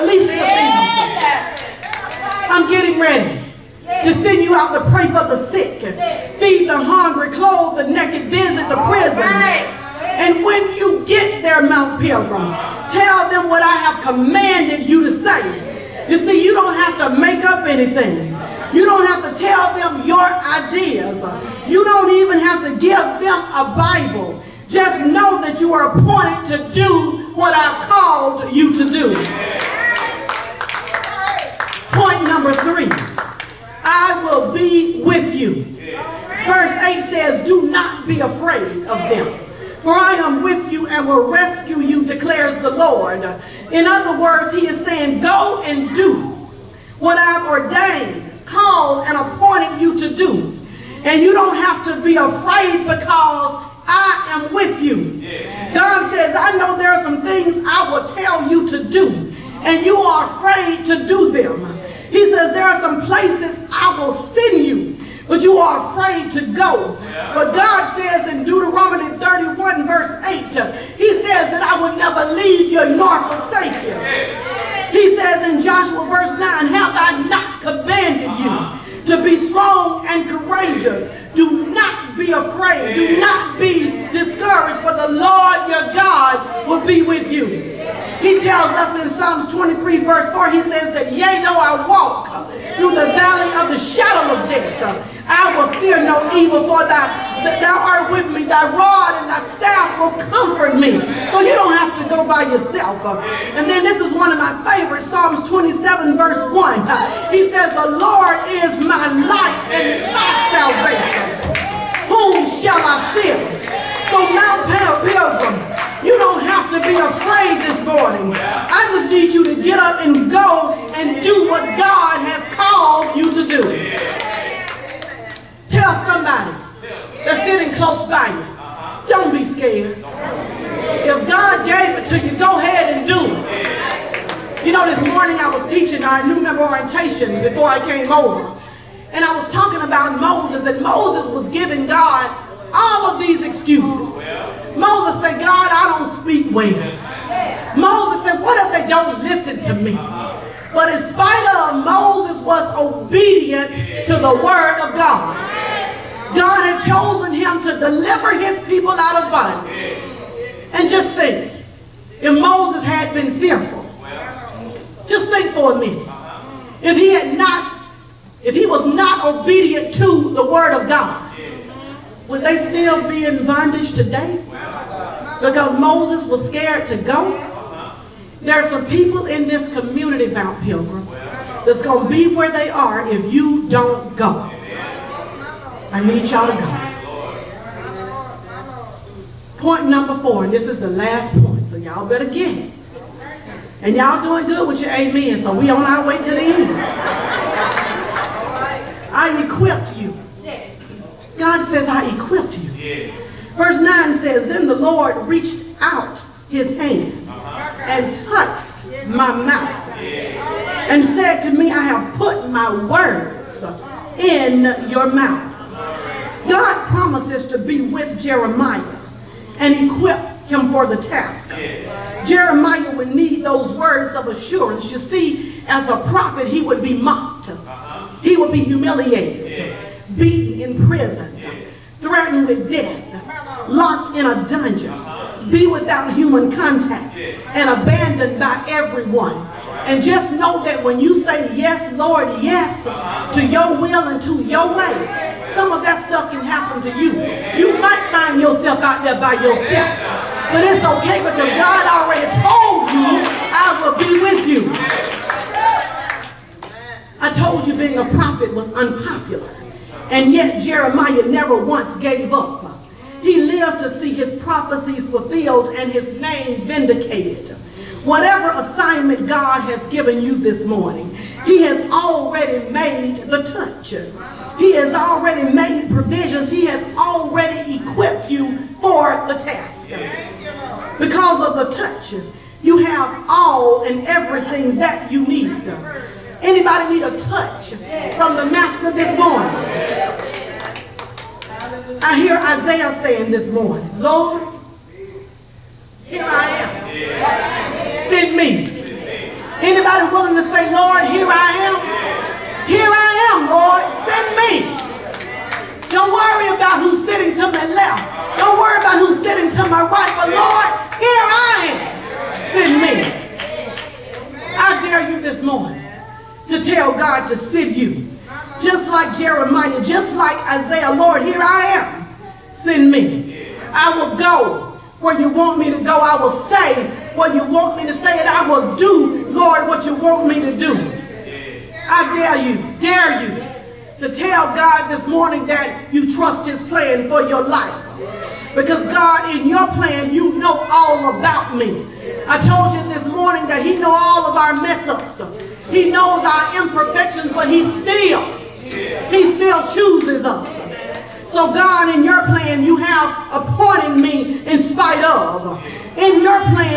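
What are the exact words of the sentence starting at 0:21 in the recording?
You don't even have to give them a Bible.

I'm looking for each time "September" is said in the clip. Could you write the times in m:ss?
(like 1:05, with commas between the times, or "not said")
not said.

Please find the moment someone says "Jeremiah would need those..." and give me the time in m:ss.
3:42.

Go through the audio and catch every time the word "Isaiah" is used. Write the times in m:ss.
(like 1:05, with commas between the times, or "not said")
4:52, 5:20.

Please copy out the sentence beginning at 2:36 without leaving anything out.
God had chosen him to deliver his people out of bondage.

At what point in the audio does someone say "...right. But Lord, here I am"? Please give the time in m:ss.
5:09.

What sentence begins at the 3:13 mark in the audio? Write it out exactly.
And y'all doing good with your amen, so we on our way to the end.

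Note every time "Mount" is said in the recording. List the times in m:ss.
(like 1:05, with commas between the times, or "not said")
0:11, 3:00.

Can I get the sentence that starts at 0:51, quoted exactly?
And you don't have to be afraid because I am with you.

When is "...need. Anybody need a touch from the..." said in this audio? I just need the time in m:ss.
4:45.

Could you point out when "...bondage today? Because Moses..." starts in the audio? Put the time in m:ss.
2:53.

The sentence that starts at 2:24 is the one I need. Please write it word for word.
Moses said, God, I don't speak well.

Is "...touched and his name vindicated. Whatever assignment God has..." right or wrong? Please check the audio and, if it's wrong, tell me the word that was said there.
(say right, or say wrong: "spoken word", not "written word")
wrong: "fulfilled", not "touched".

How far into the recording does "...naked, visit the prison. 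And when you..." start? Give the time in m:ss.
0:07.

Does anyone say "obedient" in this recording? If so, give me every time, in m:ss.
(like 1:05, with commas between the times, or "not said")
2:32, 2:49.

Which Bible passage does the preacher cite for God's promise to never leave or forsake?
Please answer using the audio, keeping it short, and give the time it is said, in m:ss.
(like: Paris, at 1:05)
Deuteronomy 31:8, at 1:08.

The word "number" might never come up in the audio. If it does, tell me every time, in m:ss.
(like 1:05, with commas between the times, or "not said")
0:32, 3:09.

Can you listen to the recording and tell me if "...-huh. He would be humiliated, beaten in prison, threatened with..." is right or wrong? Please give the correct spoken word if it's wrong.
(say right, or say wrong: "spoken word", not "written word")
right.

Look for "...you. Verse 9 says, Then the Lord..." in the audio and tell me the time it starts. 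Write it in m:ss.
3:22.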